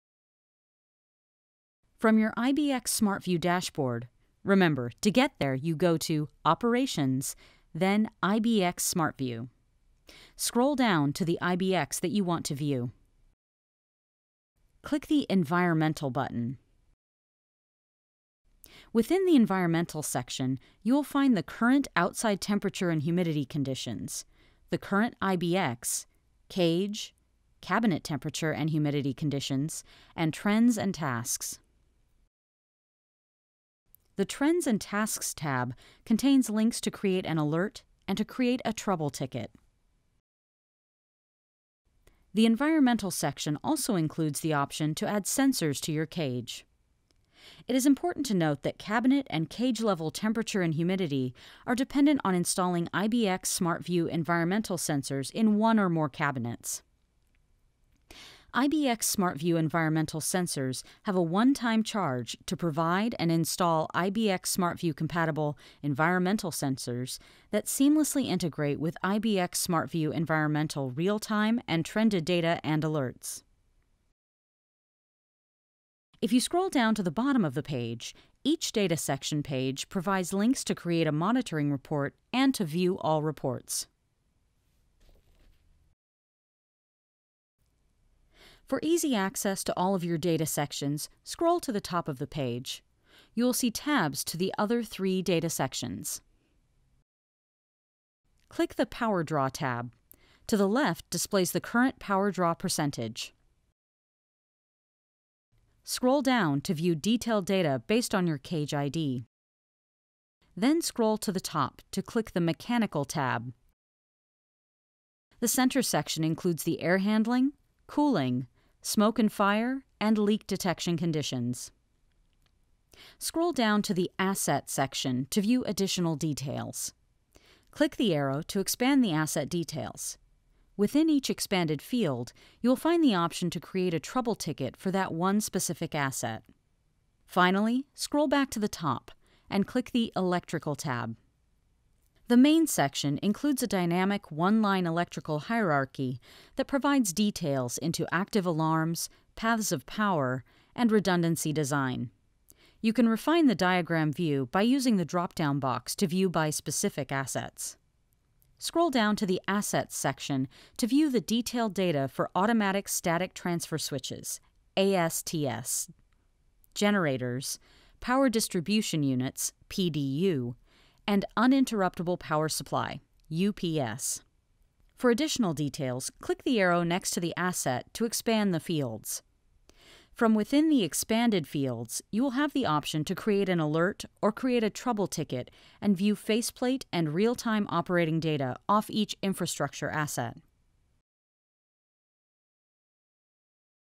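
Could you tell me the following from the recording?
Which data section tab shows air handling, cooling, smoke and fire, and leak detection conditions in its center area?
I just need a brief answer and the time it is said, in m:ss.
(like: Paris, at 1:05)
Mechanical, at 1:52.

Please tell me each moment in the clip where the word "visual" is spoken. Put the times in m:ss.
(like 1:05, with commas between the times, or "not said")
not said.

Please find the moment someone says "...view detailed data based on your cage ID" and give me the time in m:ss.
1:46.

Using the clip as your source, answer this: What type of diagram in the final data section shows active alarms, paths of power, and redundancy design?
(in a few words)
One line electrical hierarchy.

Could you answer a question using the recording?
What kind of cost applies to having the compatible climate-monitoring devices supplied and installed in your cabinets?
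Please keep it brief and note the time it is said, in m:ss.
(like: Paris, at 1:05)
One time charge, at 1:01.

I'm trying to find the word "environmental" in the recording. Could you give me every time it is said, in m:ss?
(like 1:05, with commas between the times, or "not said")
0:15, 0:19, 0:42, 0:54, 0:59, 1:05, 1:10.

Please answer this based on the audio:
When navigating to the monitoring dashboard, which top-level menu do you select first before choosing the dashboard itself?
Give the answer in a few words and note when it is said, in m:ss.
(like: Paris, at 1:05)
Operations, at 0:06.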